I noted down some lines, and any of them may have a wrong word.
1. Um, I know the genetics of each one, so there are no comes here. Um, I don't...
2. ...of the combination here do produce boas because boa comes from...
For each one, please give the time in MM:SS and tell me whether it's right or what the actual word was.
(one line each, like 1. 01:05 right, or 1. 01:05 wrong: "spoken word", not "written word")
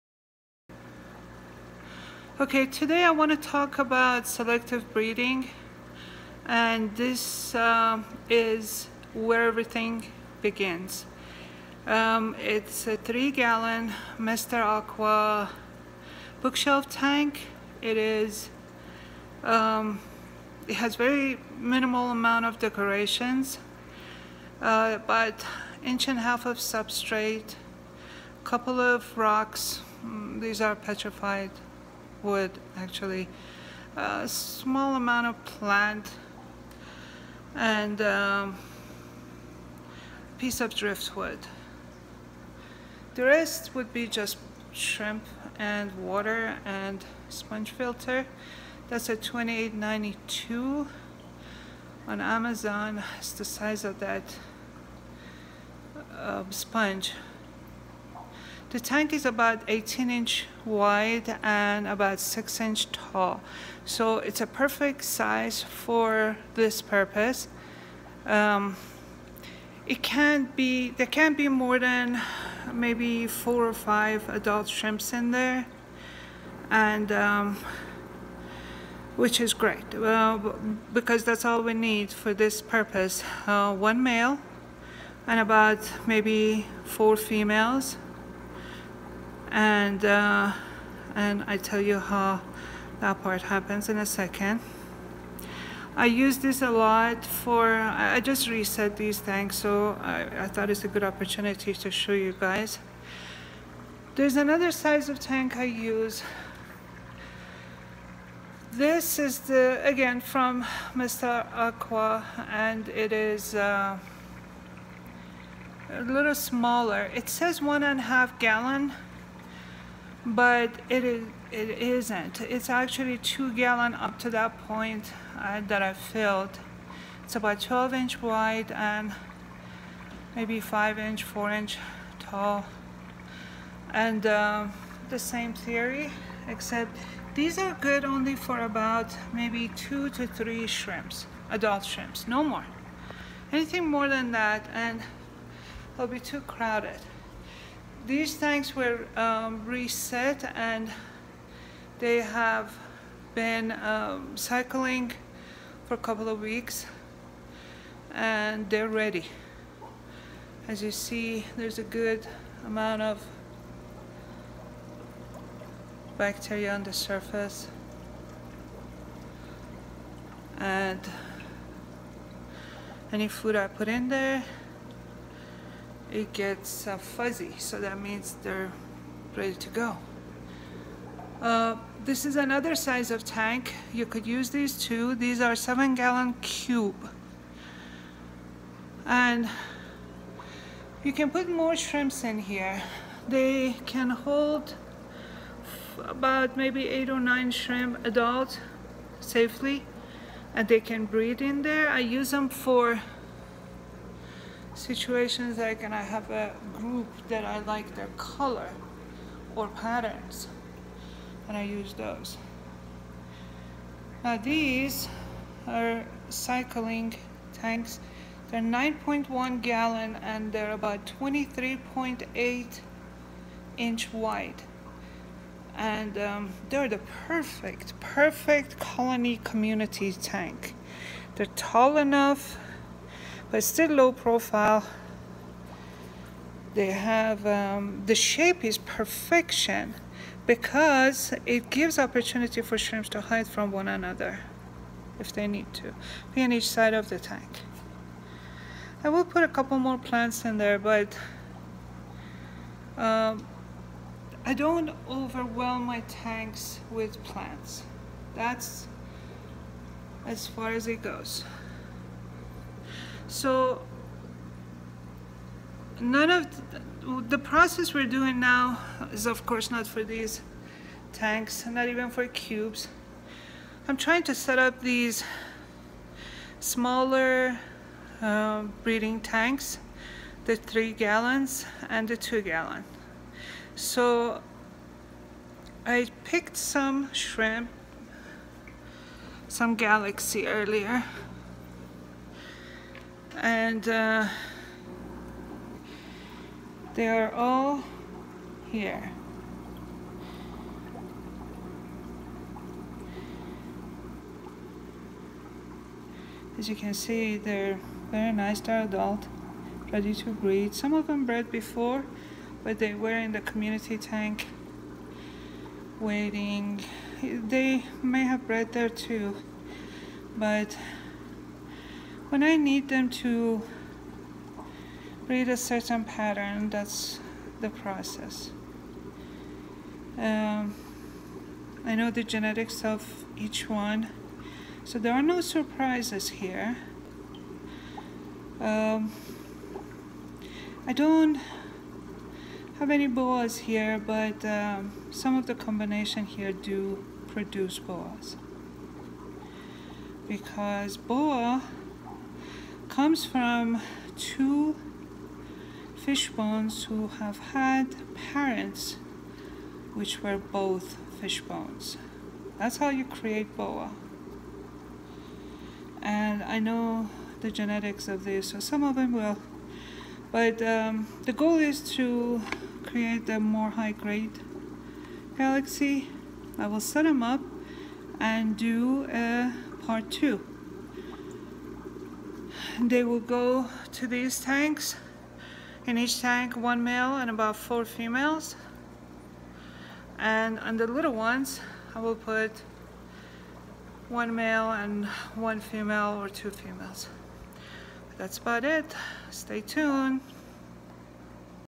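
1. 05:30 wrong: "surprises", not "comes"
2. 05:45 right.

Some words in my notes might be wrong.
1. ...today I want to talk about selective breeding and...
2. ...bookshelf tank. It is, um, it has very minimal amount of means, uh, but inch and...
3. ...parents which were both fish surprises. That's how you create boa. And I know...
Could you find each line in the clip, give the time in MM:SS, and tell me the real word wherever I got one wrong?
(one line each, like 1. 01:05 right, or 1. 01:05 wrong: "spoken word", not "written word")
1. 00:02 right
2. 00:16 wrong: "decorations", not "means"
3. 05:58 wrong: "bones", not "surprises".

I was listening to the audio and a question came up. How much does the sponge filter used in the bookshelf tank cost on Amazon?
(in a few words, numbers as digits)
$28.92.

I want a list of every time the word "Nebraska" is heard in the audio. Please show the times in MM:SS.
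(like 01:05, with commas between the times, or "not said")
not said.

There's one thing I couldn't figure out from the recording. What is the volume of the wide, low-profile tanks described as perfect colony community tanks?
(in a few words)
9.1 gallons.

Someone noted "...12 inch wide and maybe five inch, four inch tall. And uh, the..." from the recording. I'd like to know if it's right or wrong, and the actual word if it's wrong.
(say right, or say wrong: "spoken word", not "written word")
right.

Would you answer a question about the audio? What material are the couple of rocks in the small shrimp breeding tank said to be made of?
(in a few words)
Petrified wood.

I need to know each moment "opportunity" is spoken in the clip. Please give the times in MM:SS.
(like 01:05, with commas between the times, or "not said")
01:41, 04:01.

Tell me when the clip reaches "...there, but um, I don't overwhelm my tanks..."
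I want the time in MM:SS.
04:10.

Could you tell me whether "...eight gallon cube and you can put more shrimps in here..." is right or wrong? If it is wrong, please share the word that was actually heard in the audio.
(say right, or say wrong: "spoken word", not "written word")
wrong: "seven", not "eight".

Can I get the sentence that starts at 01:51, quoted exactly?
Aqua and it is uh, a little smaller it says one and a half gallon but it is it isn't.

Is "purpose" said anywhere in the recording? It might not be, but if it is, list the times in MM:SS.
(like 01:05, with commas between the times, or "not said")
01:06, 01:22.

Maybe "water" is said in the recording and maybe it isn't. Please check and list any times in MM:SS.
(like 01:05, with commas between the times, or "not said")
00:46.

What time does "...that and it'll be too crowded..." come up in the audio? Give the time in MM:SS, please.
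02:24.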